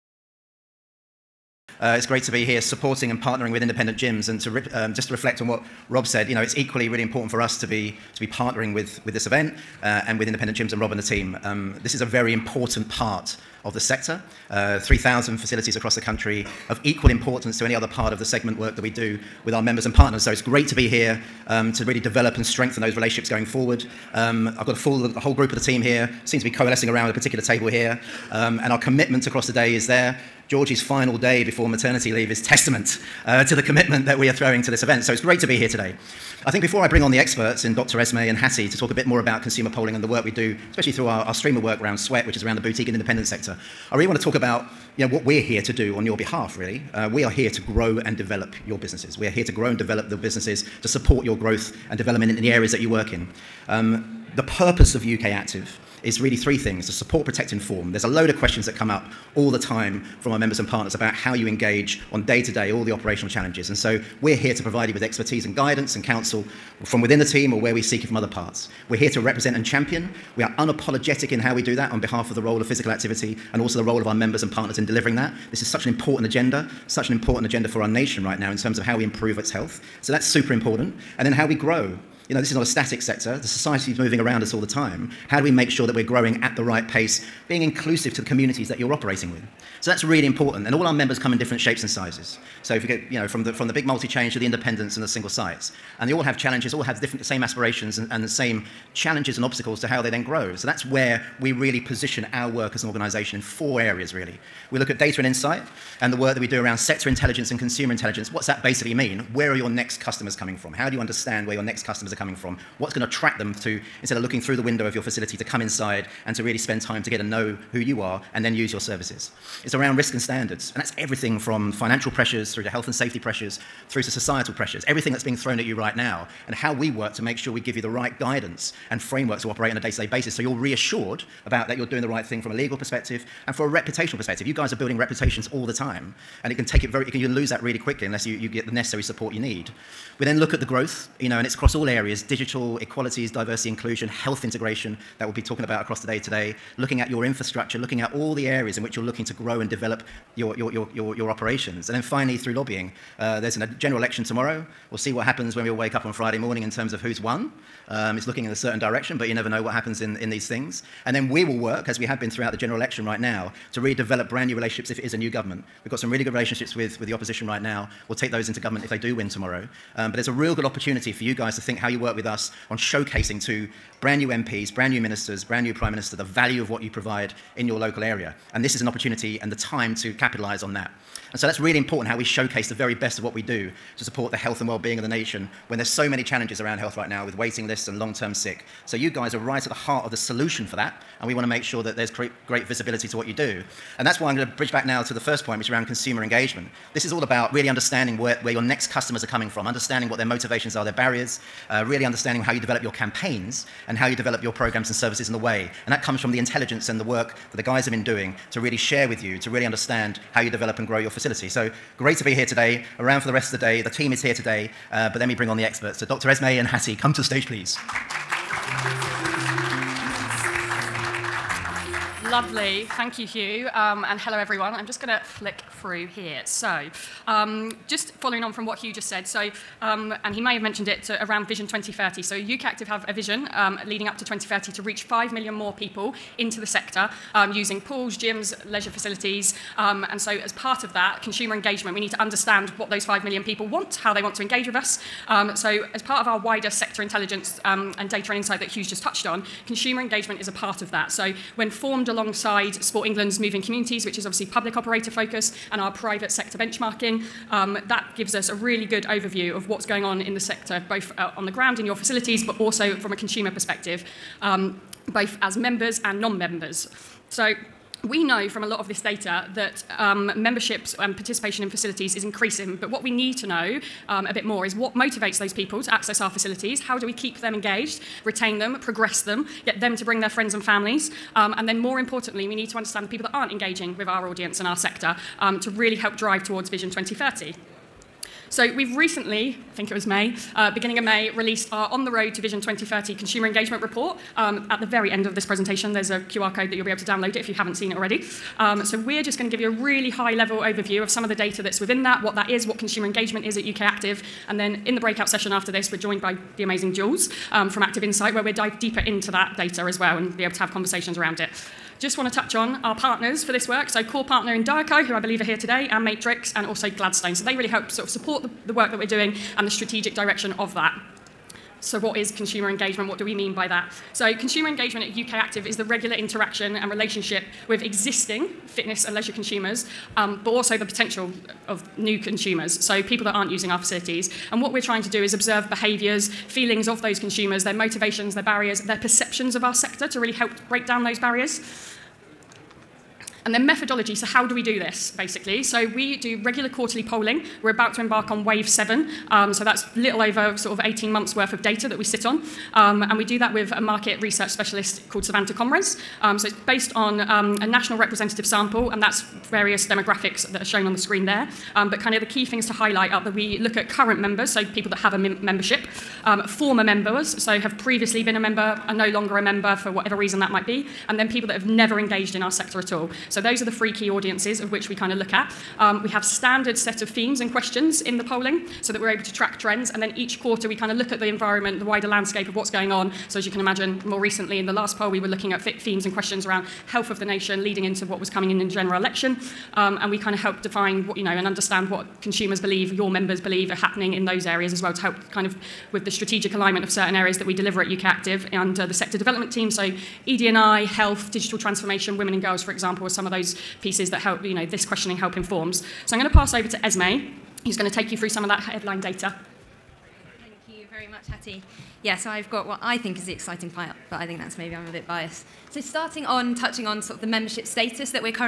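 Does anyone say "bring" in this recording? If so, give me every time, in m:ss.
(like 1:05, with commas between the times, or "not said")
0:36, 3:35, 4:40.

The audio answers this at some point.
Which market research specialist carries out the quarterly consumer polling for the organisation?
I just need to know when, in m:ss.
5:55.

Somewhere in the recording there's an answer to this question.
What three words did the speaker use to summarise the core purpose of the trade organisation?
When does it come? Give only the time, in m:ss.
0:56.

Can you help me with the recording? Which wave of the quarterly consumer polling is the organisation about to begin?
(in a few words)
wave 7.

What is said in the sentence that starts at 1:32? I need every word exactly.
So if you get, you know, from the, from the big multi-change to the independents and the single sites.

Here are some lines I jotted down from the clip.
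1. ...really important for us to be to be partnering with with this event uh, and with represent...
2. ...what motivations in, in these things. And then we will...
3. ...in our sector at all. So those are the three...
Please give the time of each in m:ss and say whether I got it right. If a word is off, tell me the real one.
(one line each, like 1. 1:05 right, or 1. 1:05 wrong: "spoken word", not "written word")
1. 0:06 wrong: "independent", not "represent"
2. 2:39 wrong: "happens", not "motivations"
3. 6:12 right.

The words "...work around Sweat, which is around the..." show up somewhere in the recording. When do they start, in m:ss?
0:41.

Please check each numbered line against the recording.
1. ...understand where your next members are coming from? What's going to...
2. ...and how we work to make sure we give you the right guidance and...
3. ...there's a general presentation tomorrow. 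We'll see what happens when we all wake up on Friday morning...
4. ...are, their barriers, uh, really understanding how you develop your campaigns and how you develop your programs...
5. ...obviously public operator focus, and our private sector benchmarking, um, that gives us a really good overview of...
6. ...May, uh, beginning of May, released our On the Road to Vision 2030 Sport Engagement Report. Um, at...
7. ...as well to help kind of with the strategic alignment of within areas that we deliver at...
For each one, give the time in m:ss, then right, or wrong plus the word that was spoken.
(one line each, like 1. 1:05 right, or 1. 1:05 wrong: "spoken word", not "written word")
1. 1:51 wrong: "customers", not "members"
2. 2:06 right
3. 2:33 wrong: "election", not "presentation"
4. 3:20 right
5. 4:14 right
6. 4:50 wrong: "Consumer", not "Sport"
7. 6:34 wrong: "certain", not "within".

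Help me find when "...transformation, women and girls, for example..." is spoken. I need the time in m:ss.
6:41.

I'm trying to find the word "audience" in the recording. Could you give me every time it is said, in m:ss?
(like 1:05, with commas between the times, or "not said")
4:44, 6:14.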